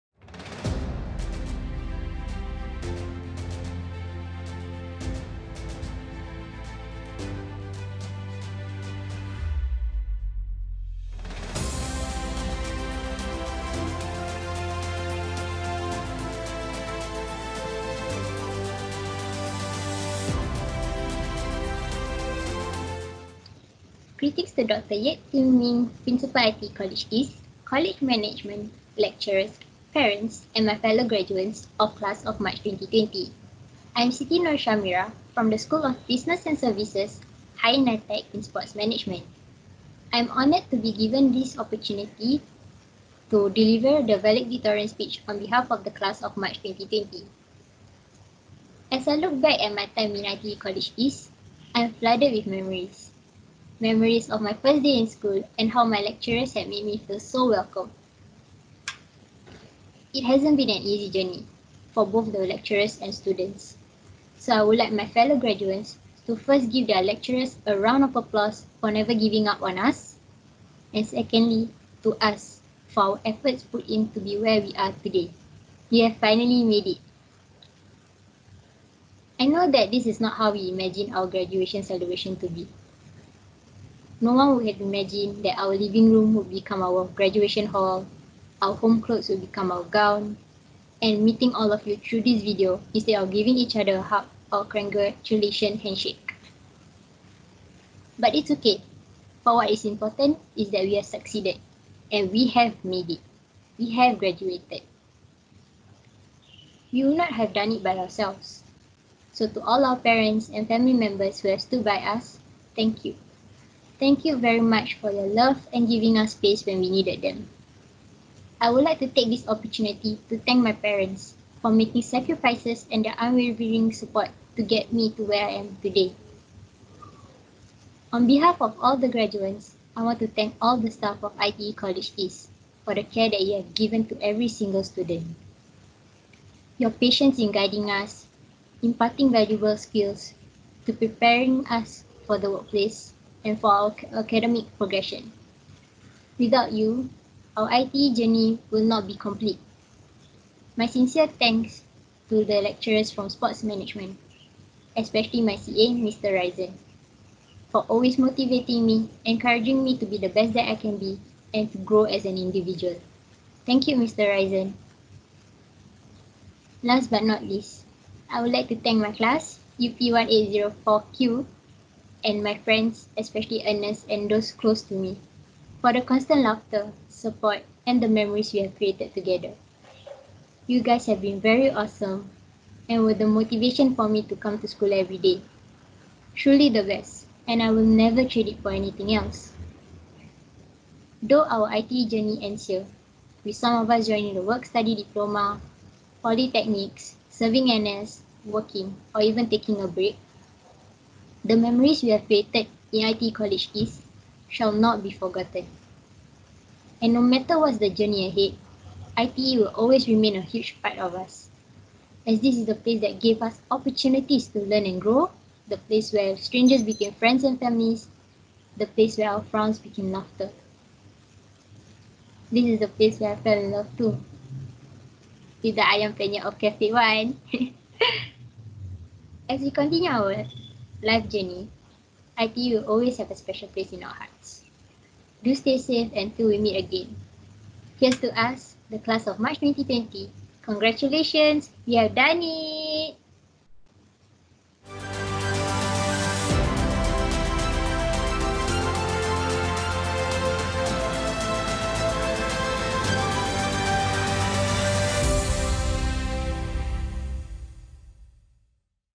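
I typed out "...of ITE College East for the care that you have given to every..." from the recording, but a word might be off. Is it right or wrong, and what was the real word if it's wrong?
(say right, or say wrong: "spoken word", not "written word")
right.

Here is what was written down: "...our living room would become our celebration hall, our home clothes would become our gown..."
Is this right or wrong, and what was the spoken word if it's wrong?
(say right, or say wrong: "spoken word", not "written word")
wrong: "graduation", not "celebration".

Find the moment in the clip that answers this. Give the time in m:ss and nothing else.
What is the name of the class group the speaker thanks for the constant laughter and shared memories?
2:49.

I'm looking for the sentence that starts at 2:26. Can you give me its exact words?
Without you, our ITE journey will not be complete.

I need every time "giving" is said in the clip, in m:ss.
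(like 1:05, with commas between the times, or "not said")
1:09, 1:33, 1:55.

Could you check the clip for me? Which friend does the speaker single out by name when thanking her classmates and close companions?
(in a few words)
Ernest.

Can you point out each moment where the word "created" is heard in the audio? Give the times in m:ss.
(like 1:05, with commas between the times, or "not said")
2:58, 3:22.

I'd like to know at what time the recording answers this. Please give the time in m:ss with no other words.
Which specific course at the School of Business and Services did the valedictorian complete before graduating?
0:37.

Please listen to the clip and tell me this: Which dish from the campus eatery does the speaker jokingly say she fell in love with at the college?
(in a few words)
Ayam penyet.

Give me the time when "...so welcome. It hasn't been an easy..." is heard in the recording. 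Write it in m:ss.
0:57.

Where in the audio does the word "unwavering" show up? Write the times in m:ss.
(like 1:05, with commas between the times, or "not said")
2:03.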